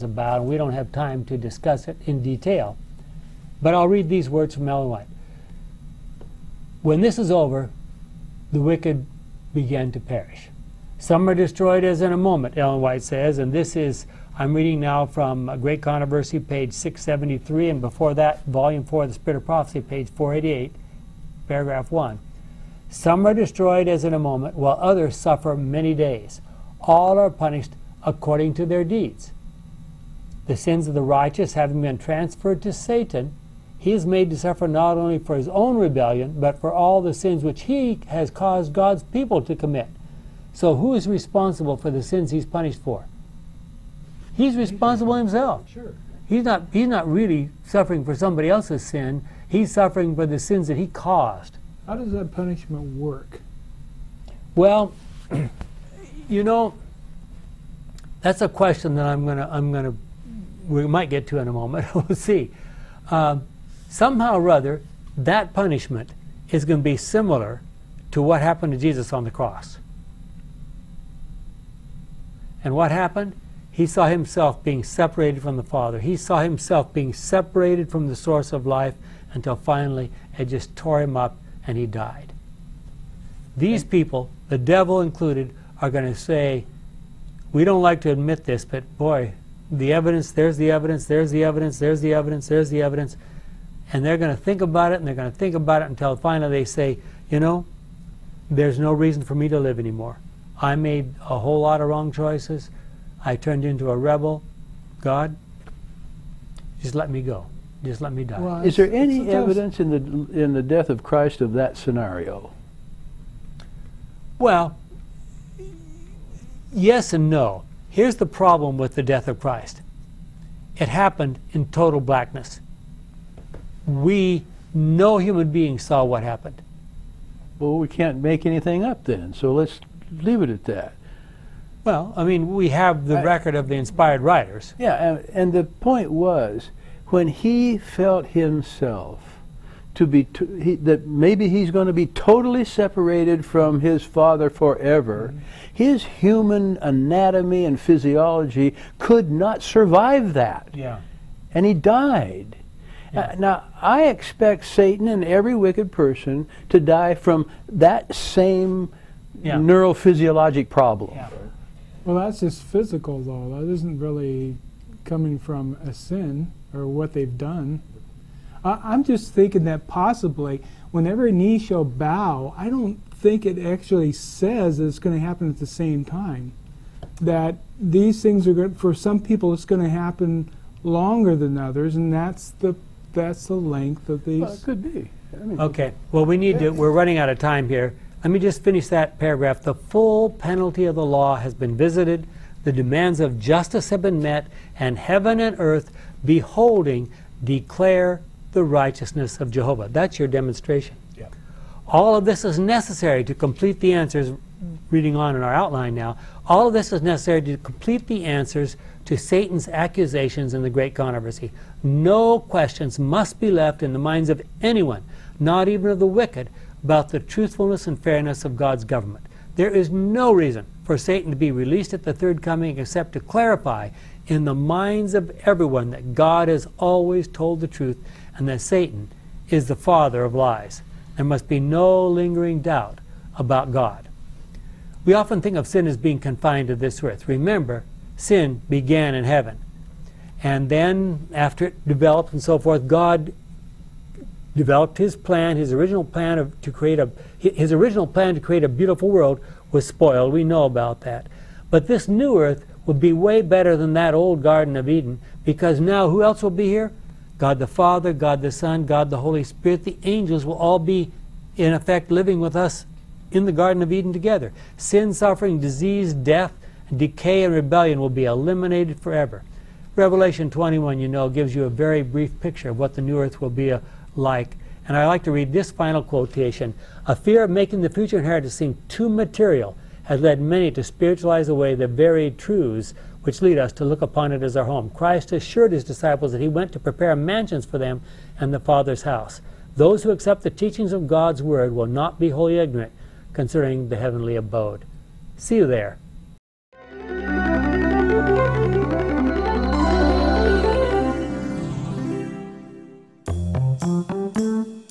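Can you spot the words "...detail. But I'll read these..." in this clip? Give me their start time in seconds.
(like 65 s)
2 s.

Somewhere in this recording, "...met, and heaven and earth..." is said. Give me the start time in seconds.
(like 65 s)
194 s.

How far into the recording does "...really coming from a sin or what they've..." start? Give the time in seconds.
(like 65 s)
163 s.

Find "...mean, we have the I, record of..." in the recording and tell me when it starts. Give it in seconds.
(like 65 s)
132 s.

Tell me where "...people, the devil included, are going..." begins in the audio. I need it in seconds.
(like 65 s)
83 s.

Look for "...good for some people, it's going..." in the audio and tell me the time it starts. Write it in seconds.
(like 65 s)
178 s.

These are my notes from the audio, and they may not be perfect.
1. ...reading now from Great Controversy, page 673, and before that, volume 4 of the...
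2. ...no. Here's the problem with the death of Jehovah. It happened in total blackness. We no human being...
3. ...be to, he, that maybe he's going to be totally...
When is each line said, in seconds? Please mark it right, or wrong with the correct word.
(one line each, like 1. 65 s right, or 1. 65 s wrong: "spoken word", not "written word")
1. 14 s right
2. 117 s wrong: "Christ", not "Jehovah"
3. 140 s right.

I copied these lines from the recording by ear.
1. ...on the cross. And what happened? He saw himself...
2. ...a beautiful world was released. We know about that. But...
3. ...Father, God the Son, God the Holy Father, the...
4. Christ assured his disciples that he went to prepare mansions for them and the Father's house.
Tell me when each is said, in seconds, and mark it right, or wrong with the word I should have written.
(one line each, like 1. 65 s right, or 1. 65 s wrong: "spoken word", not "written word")
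1. 69 s right
2. 248 s wrong: "spoiled", not "released"
3. 257 s wrong: "Spirit", not "Father"
4. 284 s right.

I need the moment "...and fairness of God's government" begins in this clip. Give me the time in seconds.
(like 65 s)
217 s.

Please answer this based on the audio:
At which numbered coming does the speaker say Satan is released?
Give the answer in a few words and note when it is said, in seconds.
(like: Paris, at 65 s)
third coming, at 222 s.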